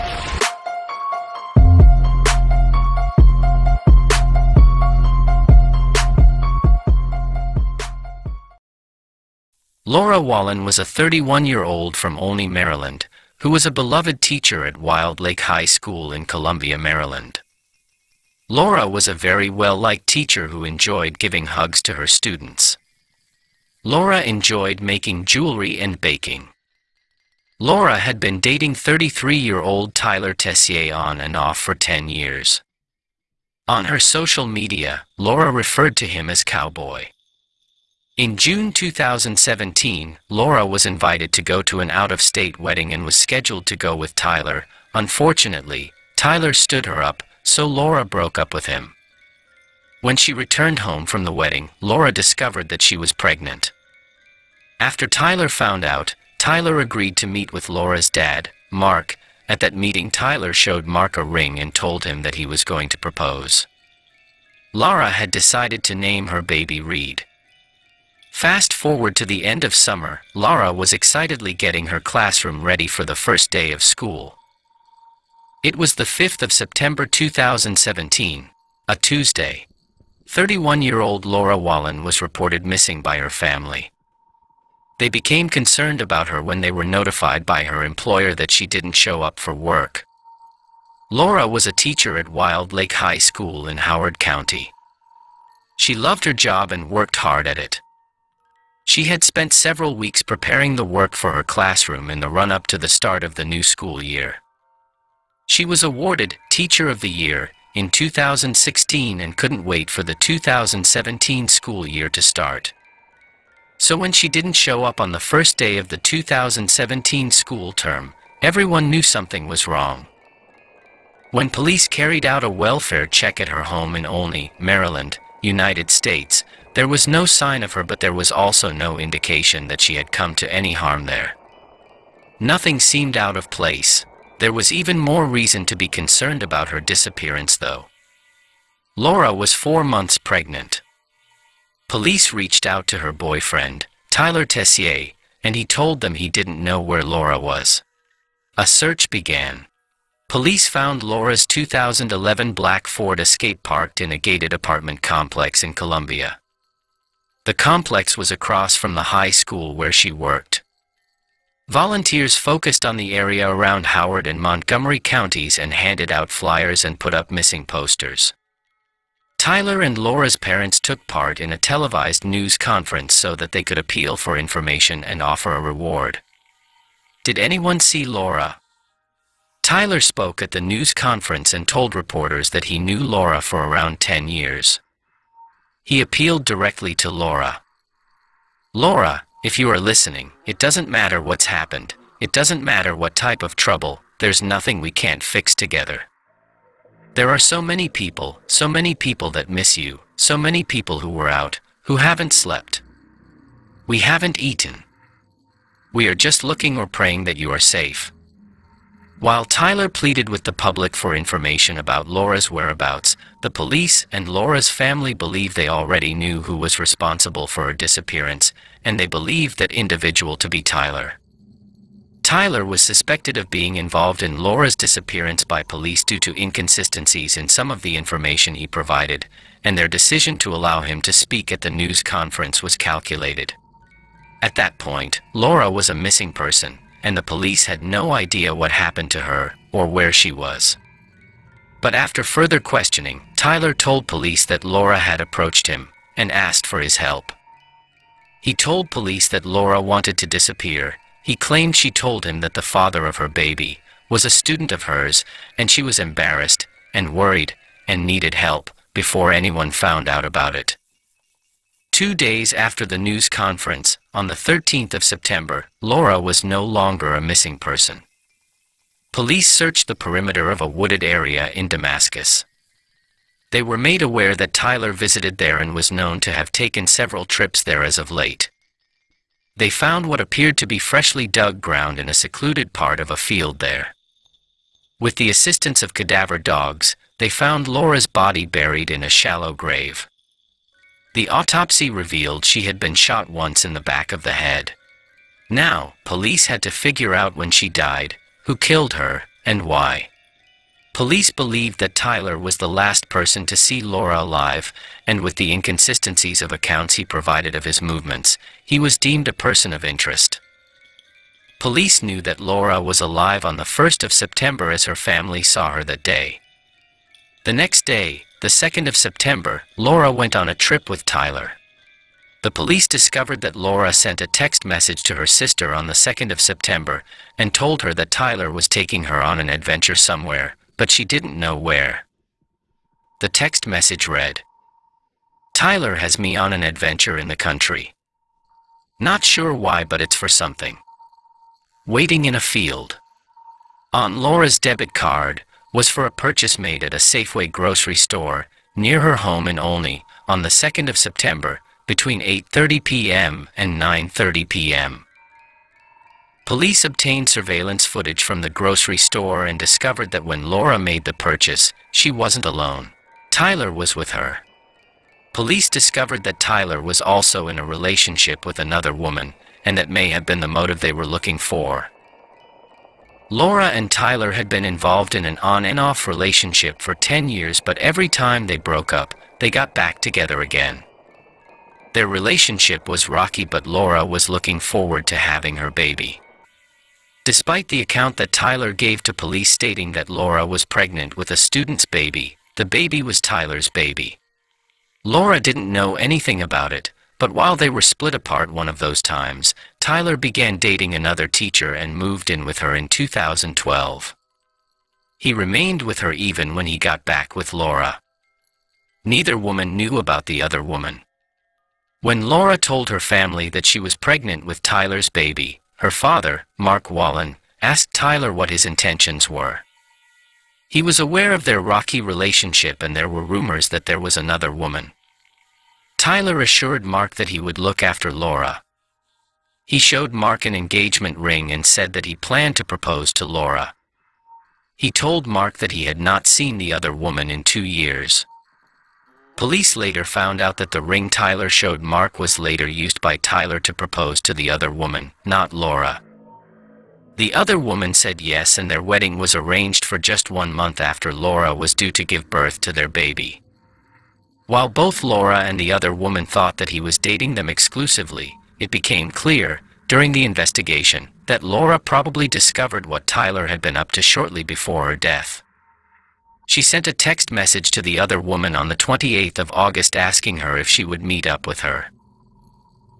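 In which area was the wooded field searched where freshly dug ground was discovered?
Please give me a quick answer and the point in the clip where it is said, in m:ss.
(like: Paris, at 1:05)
Damascus, at 4:31.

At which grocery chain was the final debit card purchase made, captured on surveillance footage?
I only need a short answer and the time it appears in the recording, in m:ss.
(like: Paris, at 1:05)
Safeway, at 5:47.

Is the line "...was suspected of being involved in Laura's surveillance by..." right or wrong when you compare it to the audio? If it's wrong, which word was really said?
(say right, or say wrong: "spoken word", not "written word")
wrong: "disappearance", not "surveillance".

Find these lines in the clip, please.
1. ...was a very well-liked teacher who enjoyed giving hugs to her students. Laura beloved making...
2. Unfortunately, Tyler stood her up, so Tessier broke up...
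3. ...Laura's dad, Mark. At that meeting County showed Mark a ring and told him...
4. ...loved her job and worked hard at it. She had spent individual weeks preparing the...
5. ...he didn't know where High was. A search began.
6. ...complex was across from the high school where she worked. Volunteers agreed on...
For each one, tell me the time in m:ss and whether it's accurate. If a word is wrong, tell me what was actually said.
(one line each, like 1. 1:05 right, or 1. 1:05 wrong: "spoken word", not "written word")
1. 0:18 wrong: "enjoyed", not "beloved"
2. 0:44 wrong: "Laura", not "Tessier"
3. 0:57 wrong: "Tyler", not "County"
4. 1:35 wrong: "several", not "individual"
5. 2:26 wrong: "Laura", not "High"
6. 2:37 wrong: "focused", not "agreed".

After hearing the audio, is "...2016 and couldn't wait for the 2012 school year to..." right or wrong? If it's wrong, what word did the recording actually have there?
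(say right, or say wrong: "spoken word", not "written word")
wrong: "2017", not "2012".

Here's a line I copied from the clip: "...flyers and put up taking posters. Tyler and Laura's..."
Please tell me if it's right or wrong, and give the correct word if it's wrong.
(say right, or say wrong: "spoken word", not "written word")
wrong: "missing", not "taking".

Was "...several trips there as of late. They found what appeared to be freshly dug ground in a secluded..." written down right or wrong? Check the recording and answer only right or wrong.
right.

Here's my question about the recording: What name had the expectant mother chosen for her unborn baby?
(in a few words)
Reed.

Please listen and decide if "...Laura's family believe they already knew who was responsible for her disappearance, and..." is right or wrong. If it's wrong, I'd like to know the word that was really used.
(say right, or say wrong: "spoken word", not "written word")
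right.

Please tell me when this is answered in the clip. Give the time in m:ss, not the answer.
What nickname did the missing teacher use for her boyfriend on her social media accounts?
0:36.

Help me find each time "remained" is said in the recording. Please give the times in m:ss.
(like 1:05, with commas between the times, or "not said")
6:45.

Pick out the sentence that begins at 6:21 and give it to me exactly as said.
Their relationship was rocky, but Laura was looking forward to having her baby.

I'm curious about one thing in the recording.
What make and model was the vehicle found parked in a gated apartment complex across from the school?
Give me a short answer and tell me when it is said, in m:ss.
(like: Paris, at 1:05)
Ford Escape, at 2:32.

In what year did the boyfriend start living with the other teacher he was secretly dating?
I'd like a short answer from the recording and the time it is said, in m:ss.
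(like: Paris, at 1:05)
2012, at 6:42.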